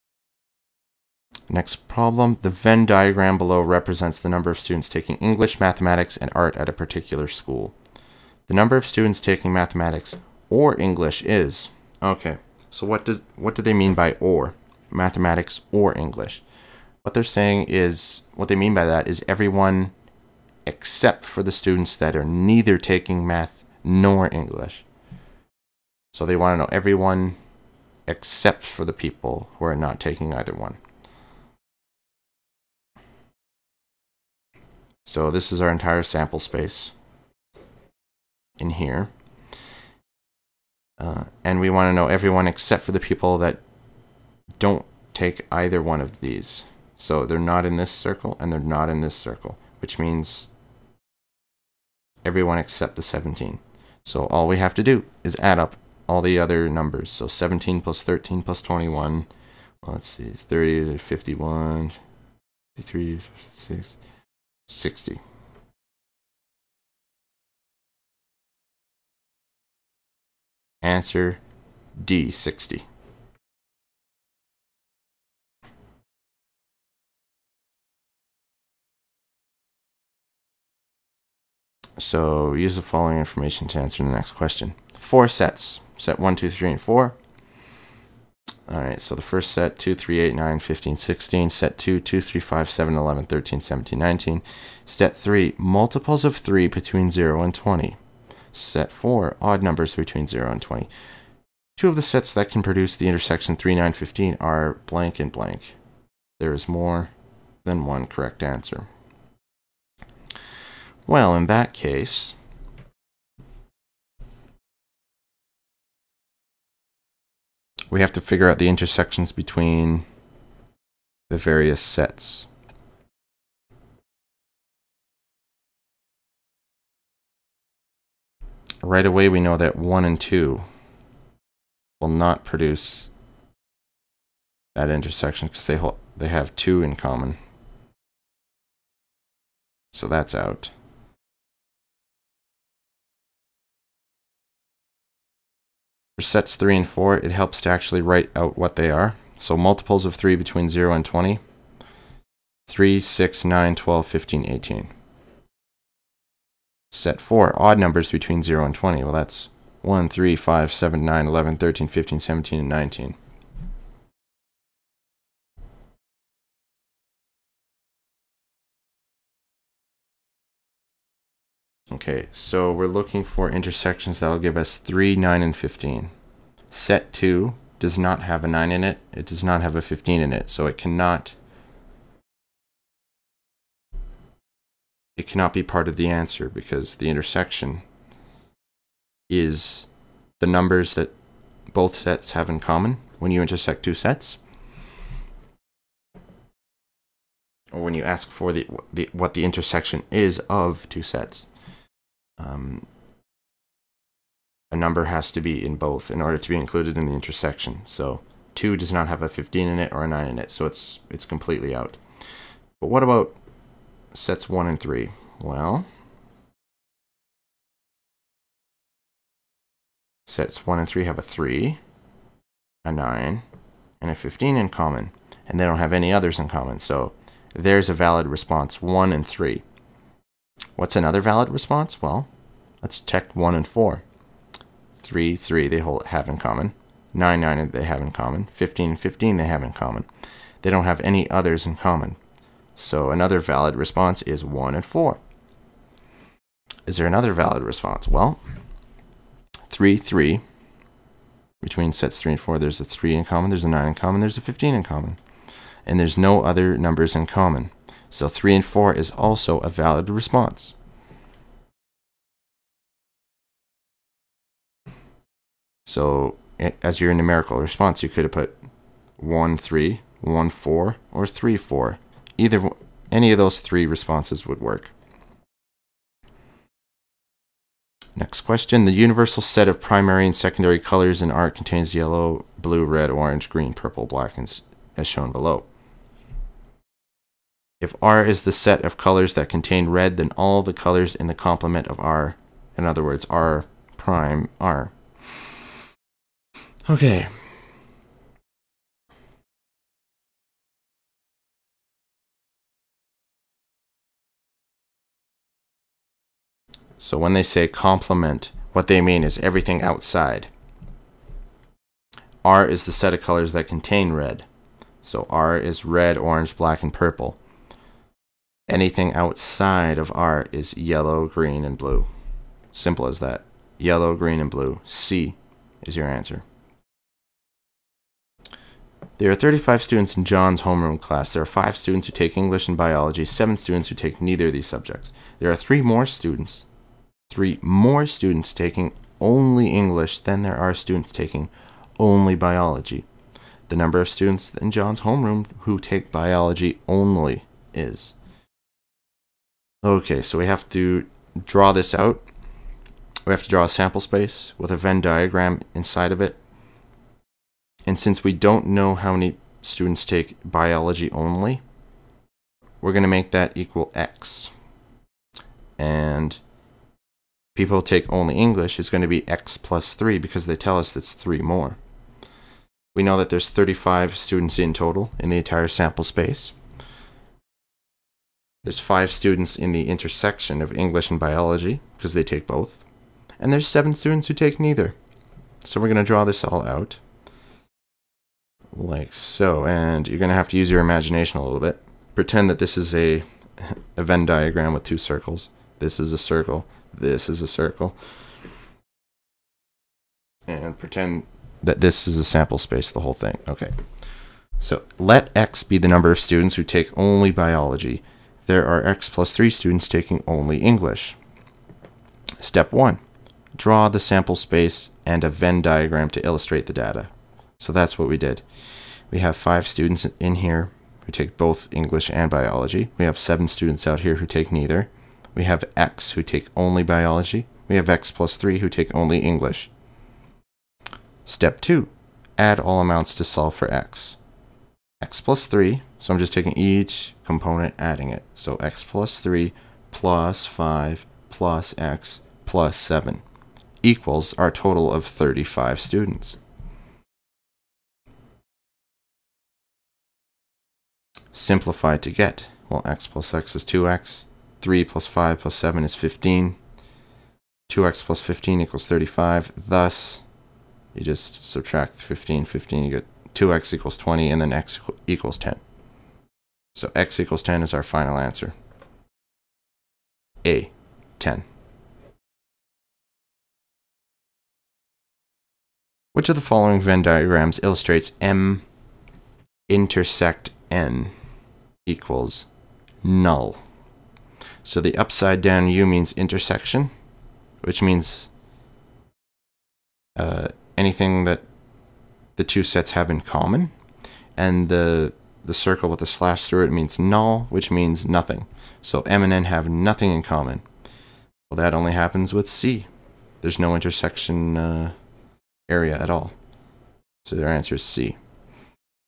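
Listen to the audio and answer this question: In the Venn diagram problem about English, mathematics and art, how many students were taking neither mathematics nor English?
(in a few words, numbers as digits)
17.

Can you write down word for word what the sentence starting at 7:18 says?
So X plus 3 plus 5 plus X plus 7 equals our total of 35 students.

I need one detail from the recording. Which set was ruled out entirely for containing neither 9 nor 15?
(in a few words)
Set 2.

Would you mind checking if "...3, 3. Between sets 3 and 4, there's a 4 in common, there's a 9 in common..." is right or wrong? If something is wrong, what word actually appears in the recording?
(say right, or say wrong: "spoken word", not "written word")
wrong: "3", not "4".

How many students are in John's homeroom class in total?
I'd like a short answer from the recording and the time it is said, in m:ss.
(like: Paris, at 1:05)
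35, at 5:29.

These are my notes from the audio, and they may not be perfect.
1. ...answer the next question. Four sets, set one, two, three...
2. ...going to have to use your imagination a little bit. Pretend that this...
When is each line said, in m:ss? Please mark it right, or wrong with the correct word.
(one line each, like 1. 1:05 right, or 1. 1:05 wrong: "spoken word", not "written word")
1. 1:23 right
2. 6:30 right.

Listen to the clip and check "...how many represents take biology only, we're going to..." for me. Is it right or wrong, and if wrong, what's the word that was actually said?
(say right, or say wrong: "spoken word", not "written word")
wrong: "students", not "represents".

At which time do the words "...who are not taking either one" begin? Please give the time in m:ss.
0:29.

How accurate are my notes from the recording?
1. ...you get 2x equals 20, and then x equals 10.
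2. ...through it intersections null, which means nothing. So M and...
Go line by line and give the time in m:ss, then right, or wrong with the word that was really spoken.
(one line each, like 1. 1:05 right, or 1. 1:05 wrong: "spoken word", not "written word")
1. 7:42 right
2. 8:16 wrong: "means", not "intersections".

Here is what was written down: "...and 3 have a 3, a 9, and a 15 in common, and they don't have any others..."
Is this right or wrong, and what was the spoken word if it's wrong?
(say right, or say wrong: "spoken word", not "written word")
right.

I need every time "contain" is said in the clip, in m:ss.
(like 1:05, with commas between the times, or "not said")
4:41, 4:49, 5:13.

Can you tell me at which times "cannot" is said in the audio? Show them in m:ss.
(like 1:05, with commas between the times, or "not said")
3:00, 3:05.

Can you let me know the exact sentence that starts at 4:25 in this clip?
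So as your numerical response, you could have put 1, 3, 1, 4, or 3, 4.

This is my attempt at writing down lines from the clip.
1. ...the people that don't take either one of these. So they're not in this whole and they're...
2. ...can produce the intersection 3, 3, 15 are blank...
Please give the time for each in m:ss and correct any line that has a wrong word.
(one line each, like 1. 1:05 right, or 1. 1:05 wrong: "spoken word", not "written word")
1. 0:42 wrong: "circle", not "whole"
2. 1:42 wrong: "9", not "3".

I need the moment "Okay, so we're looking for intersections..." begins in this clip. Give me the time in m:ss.
2:52.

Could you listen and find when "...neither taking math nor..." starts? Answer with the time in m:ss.
0:22.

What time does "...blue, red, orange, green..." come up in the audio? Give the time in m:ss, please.
4:42.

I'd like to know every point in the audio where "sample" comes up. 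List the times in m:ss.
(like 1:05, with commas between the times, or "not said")
0:36, 5:53, 6:15, 6:42, 6:53.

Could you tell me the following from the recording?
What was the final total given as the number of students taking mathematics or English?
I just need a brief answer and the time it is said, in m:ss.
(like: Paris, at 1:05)
60, at 1:10.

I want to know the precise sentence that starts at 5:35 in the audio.
There are 3 more students, 3 more students taking only English than there are students taking only biology.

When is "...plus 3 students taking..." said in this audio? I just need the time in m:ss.
6:49.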